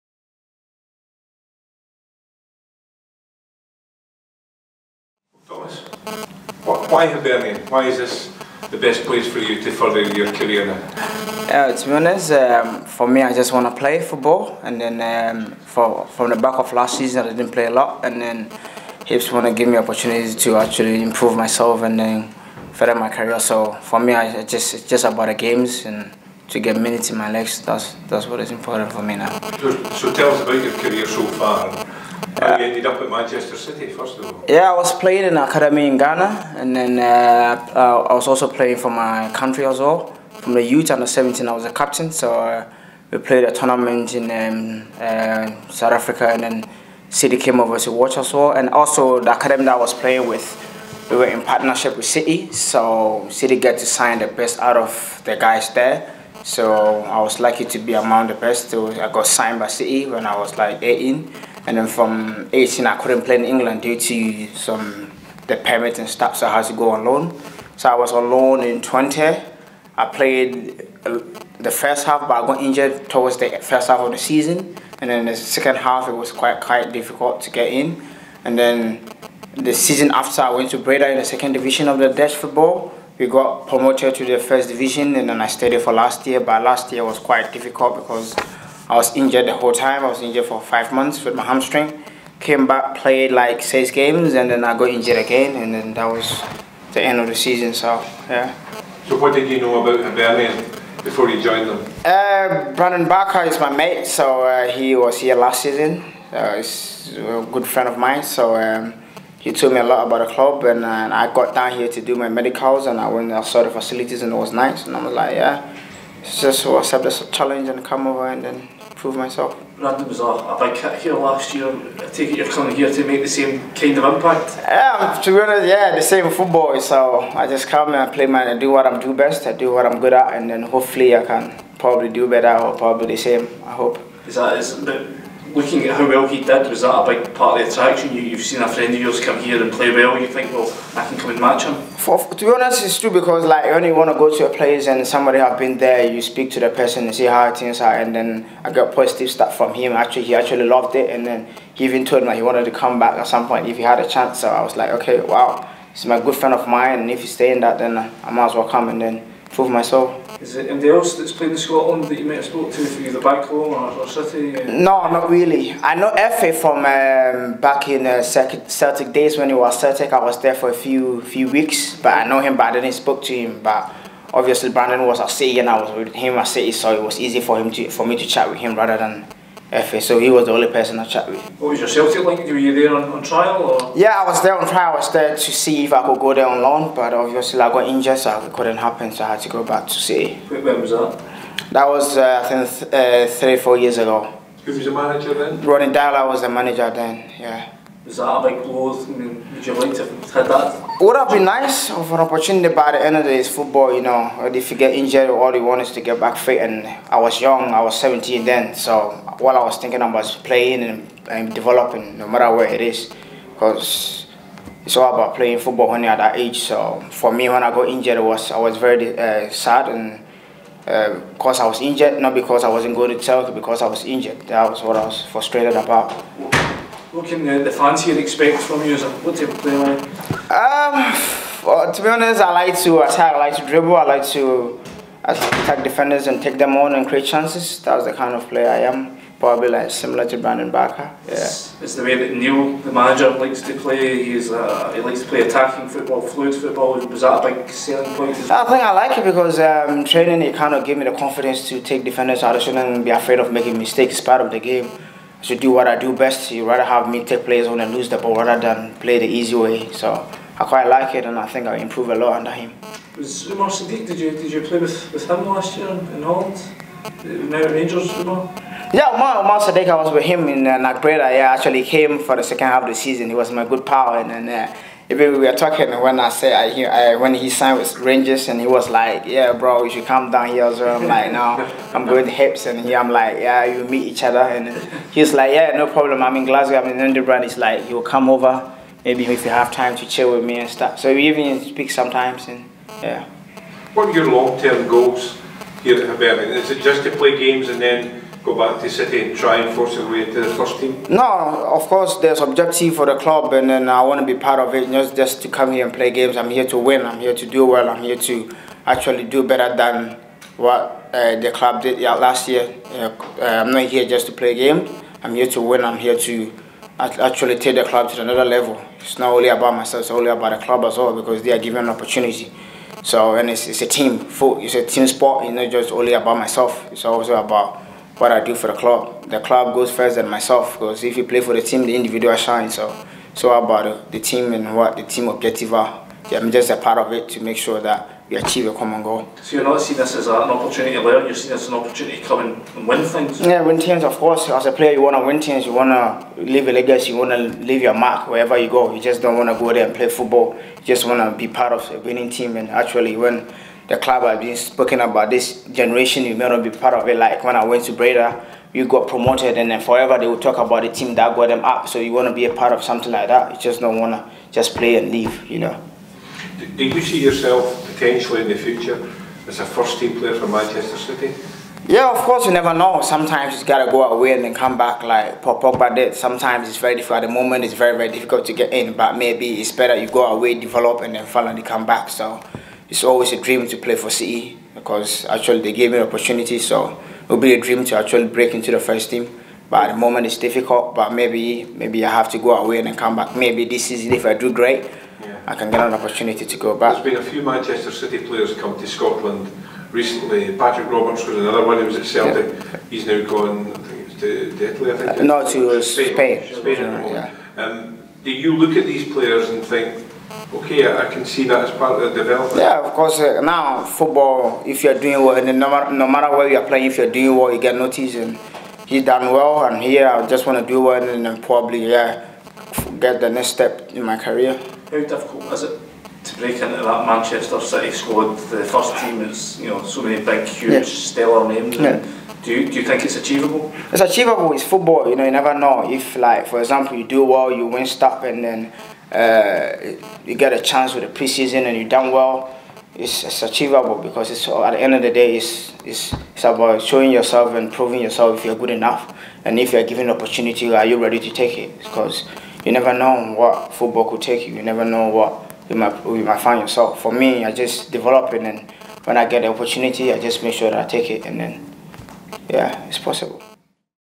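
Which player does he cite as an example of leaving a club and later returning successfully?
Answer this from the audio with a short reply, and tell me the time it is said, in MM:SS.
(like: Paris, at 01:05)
Pogba, at 06:15.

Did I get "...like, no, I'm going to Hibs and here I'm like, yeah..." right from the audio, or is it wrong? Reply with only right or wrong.
right.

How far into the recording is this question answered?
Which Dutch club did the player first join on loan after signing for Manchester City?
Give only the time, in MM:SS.
01:08.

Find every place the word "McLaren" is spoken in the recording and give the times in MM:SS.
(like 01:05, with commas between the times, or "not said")
not said.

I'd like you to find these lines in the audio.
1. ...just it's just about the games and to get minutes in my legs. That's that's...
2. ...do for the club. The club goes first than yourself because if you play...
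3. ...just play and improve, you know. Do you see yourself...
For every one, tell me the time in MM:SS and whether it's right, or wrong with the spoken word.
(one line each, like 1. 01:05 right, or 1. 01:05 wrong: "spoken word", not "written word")
1. 00:24 right
2. 05:28 wrong: "myself", not "yourself"
3. 06:04 wrong: "leave", not "improve".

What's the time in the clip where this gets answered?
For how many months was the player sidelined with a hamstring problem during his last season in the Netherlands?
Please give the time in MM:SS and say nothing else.
01:30.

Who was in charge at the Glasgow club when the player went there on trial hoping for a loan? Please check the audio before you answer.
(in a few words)
Ronny Deila.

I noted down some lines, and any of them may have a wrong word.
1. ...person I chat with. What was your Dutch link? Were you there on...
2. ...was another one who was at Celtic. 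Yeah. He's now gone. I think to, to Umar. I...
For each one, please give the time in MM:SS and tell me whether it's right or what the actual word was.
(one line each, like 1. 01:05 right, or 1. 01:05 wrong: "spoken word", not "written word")
1. 03:00 wrong: "Celtic", not "Dutch"
2. 06:41 wrong: "Italy", not "Umar".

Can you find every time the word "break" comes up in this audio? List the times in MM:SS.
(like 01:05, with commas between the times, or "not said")
06:28, 07:06.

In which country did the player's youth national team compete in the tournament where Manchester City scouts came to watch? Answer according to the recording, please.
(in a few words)
South Africa.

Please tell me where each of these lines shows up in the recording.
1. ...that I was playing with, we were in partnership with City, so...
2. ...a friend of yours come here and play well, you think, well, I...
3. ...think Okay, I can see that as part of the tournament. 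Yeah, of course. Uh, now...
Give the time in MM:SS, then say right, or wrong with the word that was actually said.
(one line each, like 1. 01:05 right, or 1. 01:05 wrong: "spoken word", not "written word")
1. 00:49 right
2. 02:18 right
3. 06:49 wrong: "development", not "tournament".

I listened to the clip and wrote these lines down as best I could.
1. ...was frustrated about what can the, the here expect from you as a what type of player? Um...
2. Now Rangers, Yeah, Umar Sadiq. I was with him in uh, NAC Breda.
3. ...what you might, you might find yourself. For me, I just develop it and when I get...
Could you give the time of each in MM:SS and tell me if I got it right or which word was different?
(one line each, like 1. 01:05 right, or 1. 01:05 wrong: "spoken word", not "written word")
1. 03:45 right
2. 04:27 right
3. 07:35 right.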